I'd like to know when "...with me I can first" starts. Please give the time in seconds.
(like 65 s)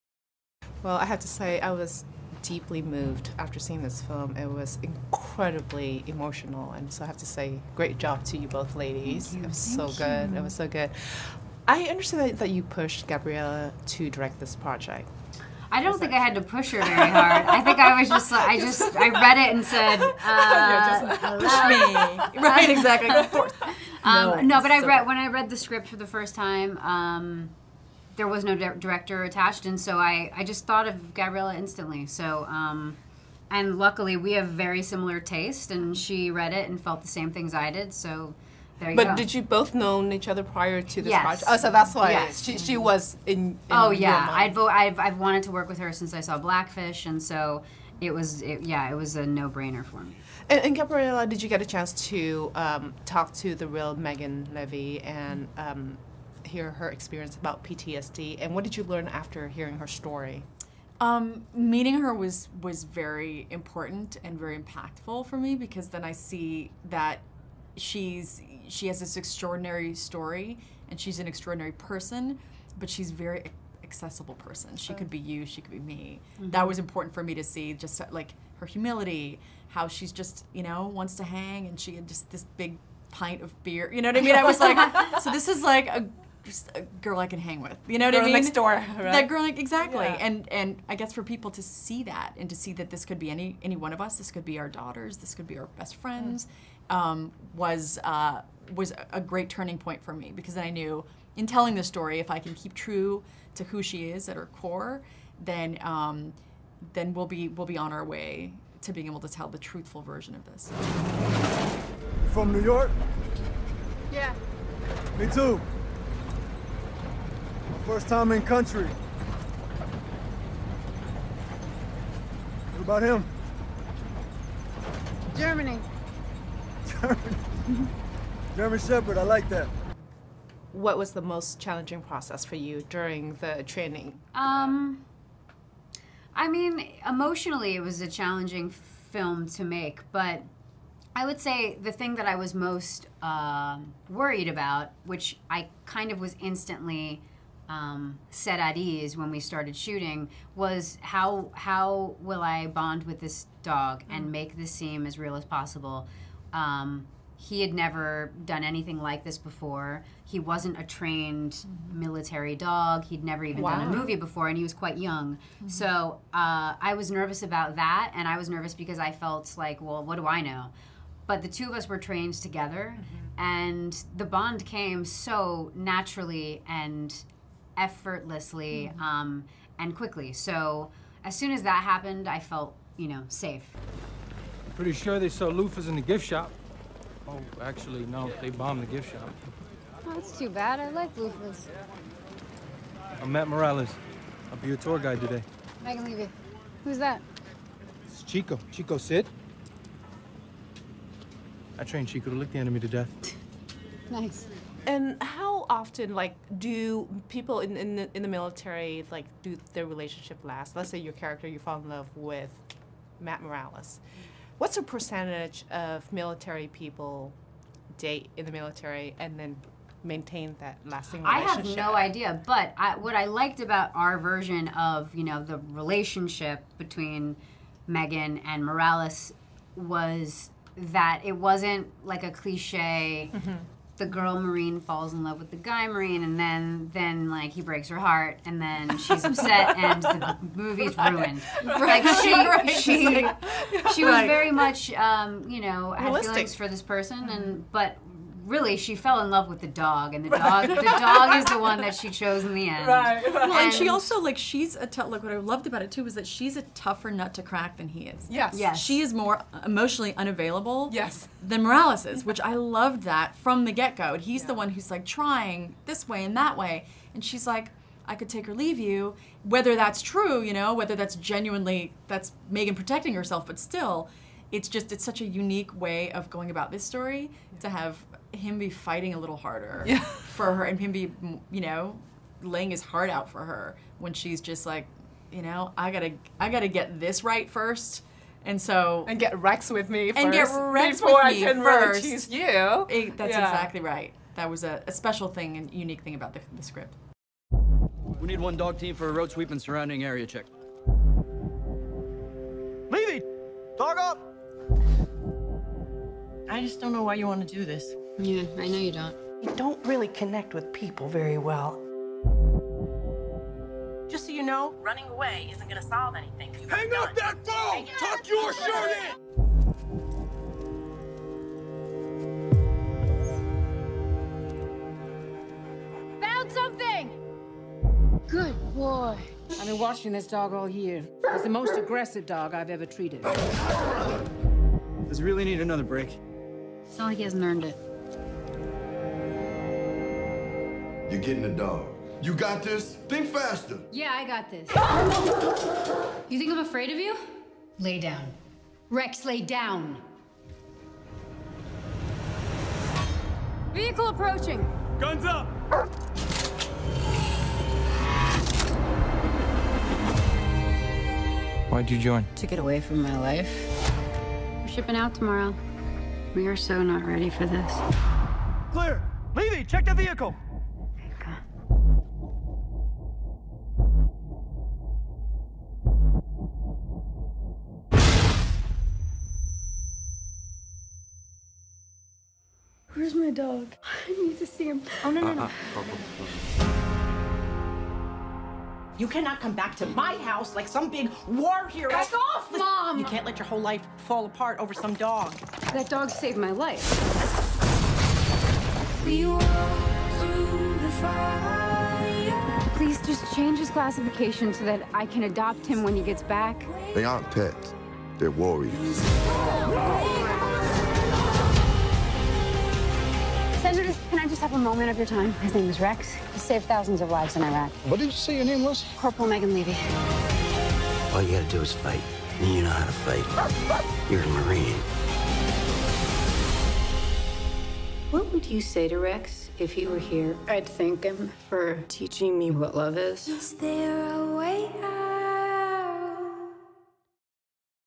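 291 s.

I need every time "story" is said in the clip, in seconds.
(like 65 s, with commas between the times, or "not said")
59 s, 69 s, 101 s, 276 s.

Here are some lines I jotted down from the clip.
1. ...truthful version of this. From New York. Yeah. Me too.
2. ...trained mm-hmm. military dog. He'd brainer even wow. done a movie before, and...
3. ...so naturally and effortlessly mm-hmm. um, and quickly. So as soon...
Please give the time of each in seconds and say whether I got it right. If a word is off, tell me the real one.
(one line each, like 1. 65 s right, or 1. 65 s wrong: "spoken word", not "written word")
1. 109 s right
2. 160 s wrong: "never", not "brainer"
3. 175 s right.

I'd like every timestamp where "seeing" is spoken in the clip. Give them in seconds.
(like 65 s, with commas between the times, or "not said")
3 s.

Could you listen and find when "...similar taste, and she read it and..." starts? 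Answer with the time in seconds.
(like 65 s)
34 s.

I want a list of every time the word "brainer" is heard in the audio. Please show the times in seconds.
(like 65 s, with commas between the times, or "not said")
49 s.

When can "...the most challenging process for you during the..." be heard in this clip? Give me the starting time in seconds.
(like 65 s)
131 s.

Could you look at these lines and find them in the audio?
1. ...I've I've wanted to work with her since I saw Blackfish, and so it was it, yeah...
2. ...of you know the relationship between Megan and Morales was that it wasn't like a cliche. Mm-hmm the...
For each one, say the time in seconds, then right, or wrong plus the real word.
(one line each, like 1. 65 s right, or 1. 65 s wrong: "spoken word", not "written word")
1. 44 s right
2. 224 s right.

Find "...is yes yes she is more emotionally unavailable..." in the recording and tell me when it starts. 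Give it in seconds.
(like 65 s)
258 s.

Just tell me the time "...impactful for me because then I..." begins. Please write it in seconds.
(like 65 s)
64 s.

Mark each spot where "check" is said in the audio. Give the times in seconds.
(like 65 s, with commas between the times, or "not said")
300 s, 369 s.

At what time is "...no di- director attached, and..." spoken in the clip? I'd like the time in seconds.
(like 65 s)
28 s.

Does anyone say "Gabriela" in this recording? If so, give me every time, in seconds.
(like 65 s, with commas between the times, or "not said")
13 s, 31 s, 50 s.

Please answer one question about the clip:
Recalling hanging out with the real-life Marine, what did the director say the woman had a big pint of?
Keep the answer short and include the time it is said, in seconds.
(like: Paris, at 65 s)
Beer, at 83 s.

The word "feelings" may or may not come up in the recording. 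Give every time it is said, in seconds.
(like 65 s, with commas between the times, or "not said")
246 s.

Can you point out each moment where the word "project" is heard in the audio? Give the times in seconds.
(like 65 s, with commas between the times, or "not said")
14 s, 41 s.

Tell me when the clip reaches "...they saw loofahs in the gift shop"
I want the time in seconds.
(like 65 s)
185 s.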